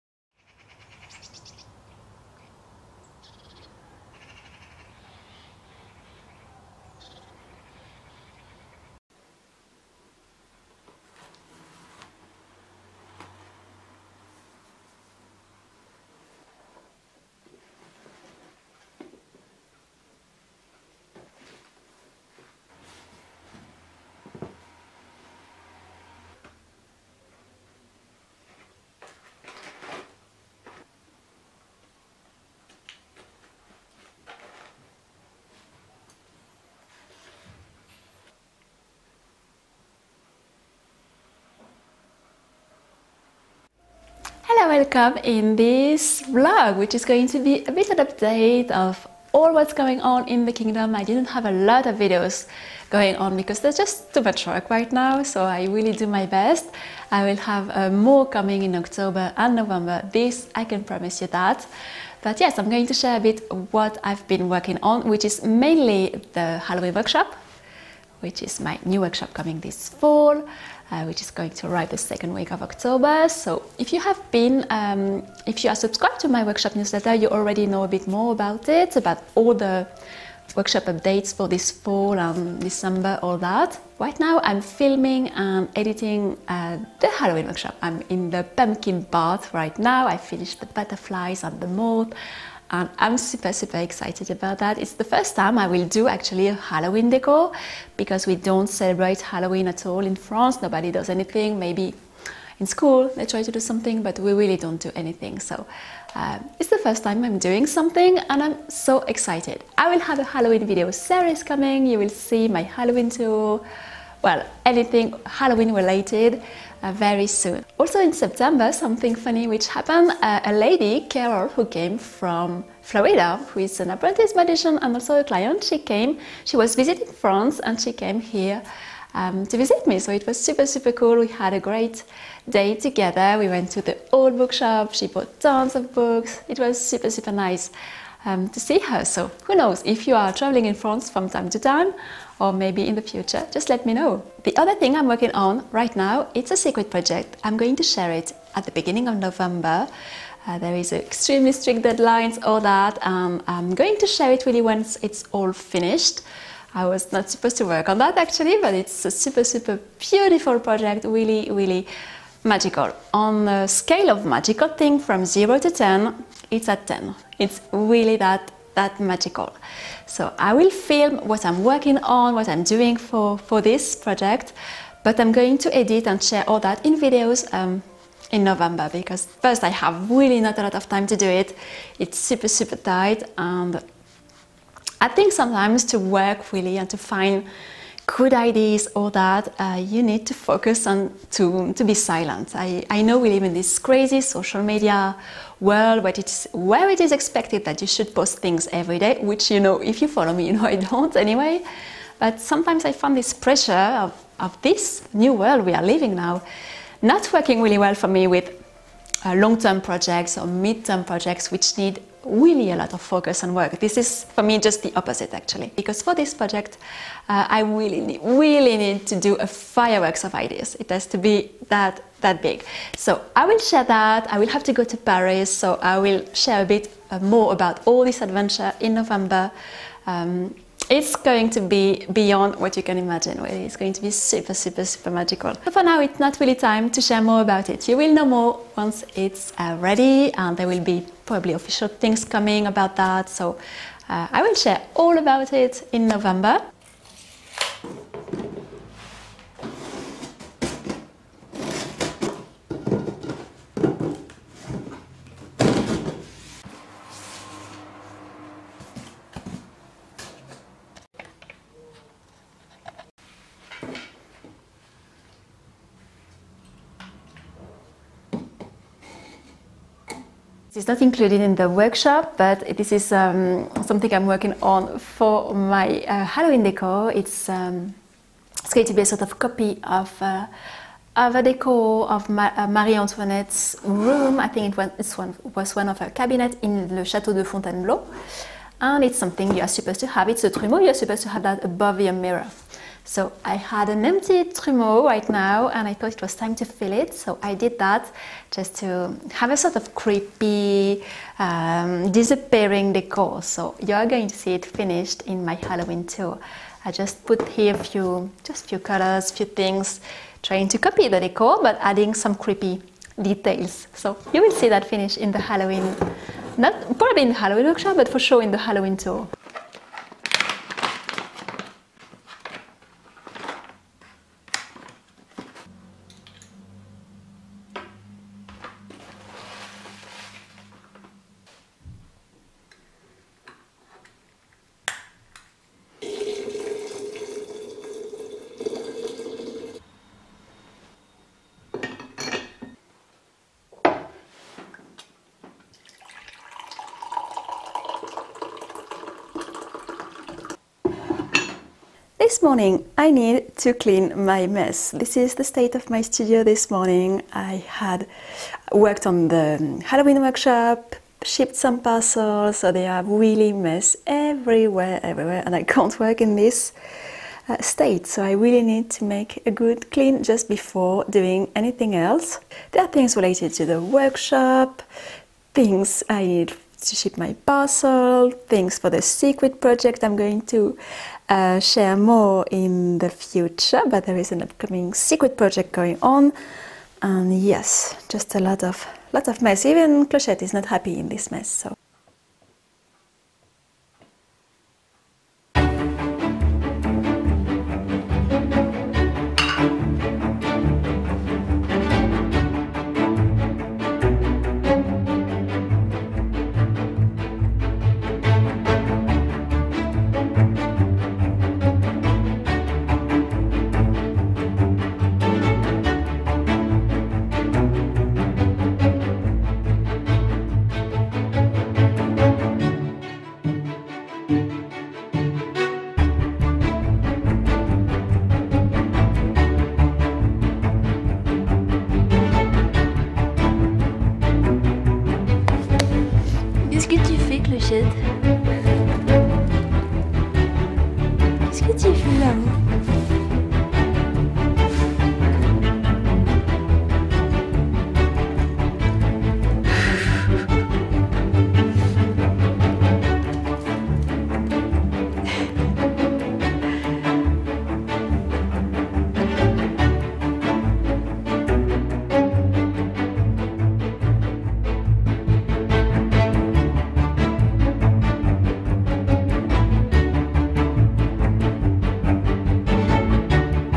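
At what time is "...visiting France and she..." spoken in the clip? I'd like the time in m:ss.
2:06.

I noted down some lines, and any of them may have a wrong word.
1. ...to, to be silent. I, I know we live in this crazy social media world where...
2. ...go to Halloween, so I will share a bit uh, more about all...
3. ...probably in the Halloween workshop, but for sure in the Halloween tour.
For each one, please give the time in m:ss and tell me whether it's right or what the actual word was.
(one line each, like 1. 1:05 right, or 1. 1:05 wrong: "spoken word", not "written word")
1. 3:11 right
2. 3:44 wrong: "Paris", not "Halloween"
3. 5:16 right.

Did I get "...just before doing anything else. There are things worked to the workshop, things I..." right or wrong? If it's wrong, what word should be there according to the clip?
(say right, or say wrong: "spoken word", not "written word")
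wrong: "related", not "worked".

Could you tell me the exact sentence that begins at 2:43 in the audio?
On the scale of magical thing from 0 to 10, it's at 10.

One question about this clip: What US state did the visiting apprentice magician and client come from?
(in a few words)
Florida.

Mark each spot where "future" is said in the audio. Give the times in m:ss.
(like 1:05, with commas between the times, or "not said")
2:23, 6:23.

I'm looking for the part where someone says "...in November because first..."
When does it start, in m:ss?
2:58.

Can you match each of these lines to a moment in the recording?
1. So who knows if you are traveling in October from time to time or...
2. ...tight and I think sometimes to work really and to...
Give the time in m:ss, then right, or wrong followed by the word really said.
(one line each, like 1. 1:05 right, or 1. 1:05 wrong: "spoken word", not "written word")
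1. 2:19 wrong: "France", not "October"
2. 3:02 right.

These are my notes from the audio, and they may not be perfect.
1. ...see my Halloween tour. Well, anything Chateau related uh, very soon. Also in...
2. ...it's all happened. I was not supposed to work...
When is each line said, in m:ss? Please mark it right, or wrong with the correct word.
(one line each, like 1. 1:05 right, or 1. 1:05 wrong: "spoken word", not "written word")
1. 1:52 wrong: "Halloween", not "Chateau"
2. 2:35 wrong: "finished", not "happened".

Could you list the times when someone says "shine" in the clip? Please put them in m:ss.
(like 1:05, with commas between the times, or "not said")
not said.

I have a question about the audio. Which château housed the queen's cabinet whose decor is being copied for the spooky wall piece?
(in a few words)
Chateau de Fontainebleau.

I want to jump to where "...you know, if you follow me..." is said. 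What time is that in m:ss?
3:19.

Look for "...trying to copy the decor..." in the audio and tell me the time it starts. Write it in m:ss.
5:10.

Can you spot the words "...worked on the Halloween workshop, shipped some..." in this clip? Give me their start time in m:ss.
5:58.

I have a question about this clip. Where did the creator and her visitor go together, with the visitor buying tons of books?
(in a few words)
Old bookshop.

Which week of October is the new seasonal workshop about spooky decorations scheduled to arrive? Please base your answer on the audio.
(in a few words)
Second week.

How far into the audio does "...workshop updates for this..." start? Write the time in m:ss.
1:20.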